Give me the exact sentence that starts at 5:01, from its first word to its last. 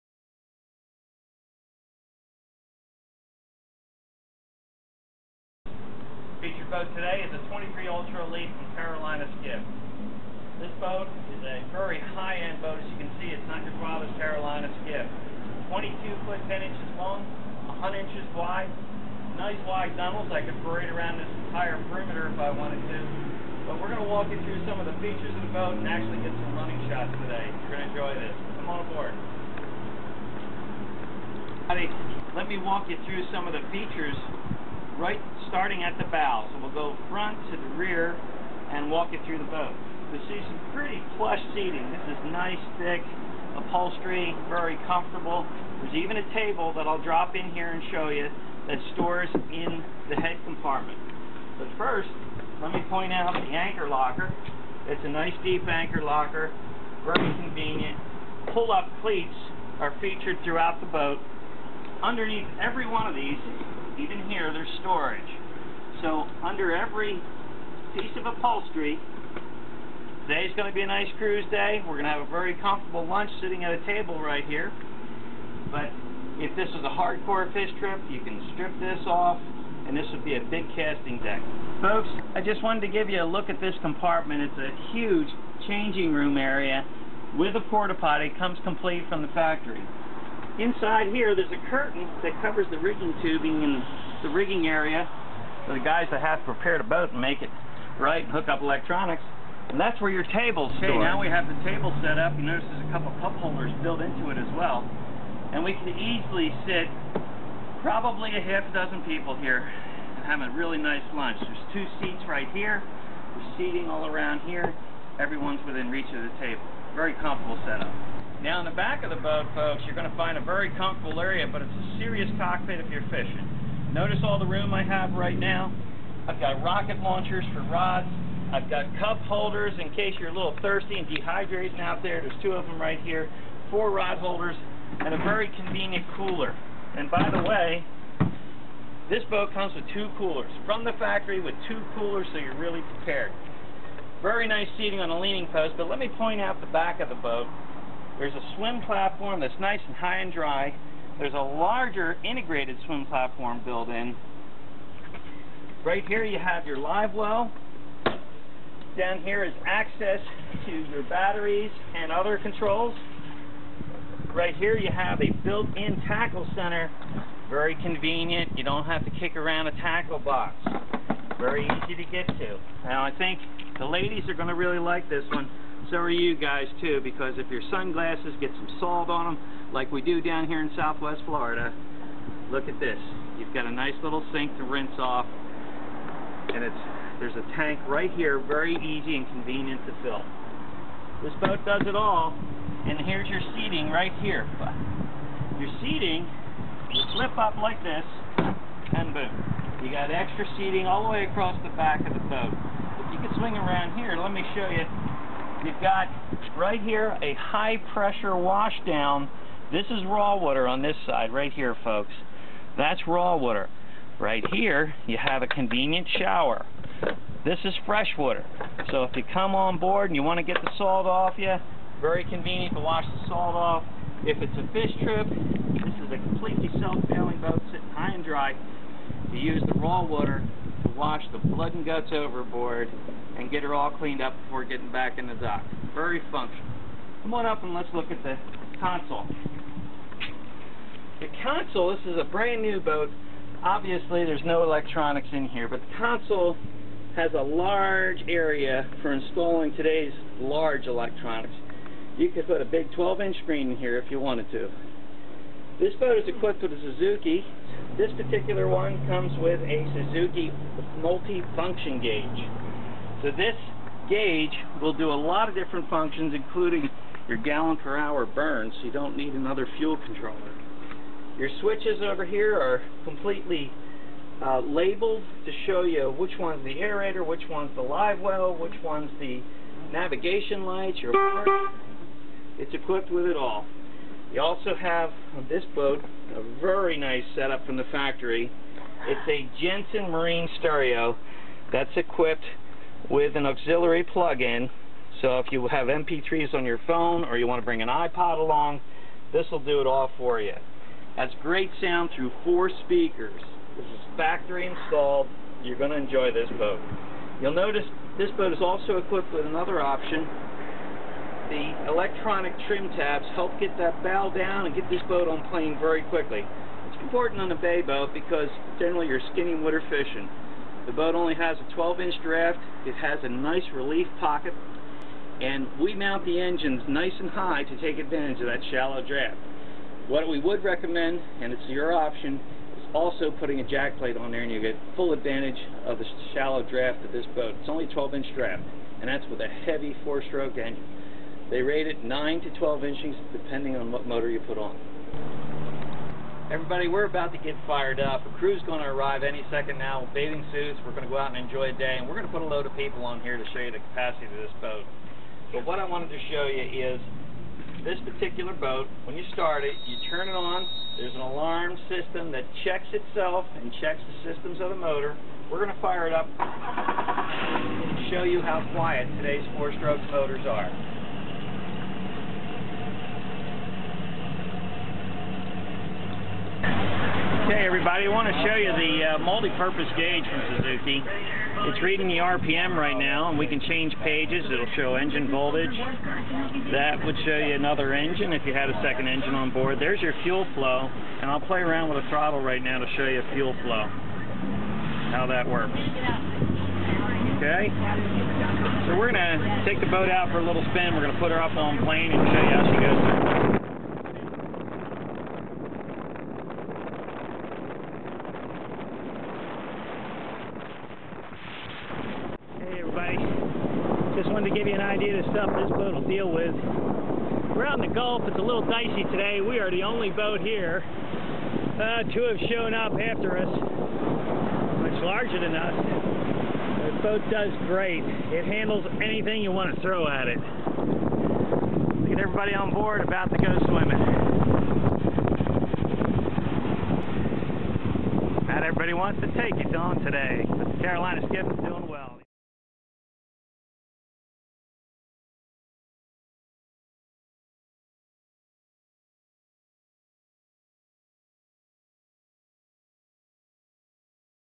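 That's great sound through four speakers.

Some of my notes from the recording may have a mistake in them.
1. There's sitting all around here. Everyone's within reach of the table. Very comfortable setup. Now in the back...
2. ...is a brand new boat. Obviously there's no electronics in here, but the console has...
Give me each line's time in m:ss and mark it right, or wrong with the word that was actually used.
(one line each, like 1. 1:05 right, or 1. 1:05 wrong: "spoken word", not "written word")
1. 1:52 wrong: "seating", not "sitting"
2. 4:02 right.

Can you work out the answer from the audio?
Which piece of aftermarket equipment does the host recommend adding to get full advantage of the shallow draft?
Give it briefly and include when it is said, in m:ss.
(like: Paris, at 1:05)
Jack plate, at 5:33.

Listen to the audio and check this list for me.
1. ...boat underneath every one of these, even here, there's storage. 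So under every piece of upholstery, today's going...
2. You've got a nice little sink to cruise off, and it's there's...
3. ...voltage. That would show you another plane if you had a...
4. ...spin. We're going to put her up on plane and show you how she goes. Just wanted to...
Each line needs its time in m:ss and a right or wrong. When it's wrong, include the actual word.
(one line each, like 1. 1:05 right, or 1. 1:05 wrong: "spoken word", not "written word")
1. 1:00 right
2. 3:03 wrong: "rinse", not "cruise"
3. 6:25 wrong: "engine", not "plane"
4. 6:40 right.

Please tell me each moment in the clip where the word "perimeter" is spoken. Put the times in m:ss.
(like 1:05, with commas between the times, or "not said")
0:21.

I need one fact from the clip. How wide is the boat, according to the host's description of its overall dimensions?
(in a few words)
100 inches.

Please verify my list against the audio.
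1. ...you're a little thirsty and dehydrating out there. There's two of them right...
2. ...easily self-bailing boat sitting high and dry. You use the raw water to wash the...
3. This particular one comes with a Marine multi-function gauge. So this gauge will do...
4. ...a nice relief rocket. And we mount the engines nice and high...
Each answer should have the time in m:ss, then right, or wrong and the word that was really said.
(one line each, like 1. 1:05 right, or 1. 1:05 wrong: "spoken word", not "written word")
1. 2:10 right
2. 3:46 wrong: "completely", not "easily"
3. 4:17 wrong: "Suzuki", not "Marine"
4. 5:23 wrong: "pocket", not "rocket".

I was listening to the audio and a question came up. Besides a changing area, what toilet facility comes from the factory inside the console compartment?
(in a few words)
Porta potty.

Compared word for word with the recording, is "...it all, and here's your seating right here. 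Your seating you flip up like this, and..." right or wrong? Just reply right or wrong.
right.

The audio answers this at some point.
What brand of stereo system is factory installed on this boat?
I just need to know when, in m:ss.
4:49.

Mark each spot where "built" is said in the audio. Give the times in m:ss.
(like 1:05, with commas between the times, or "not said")
1:43, 2:33, 2:45.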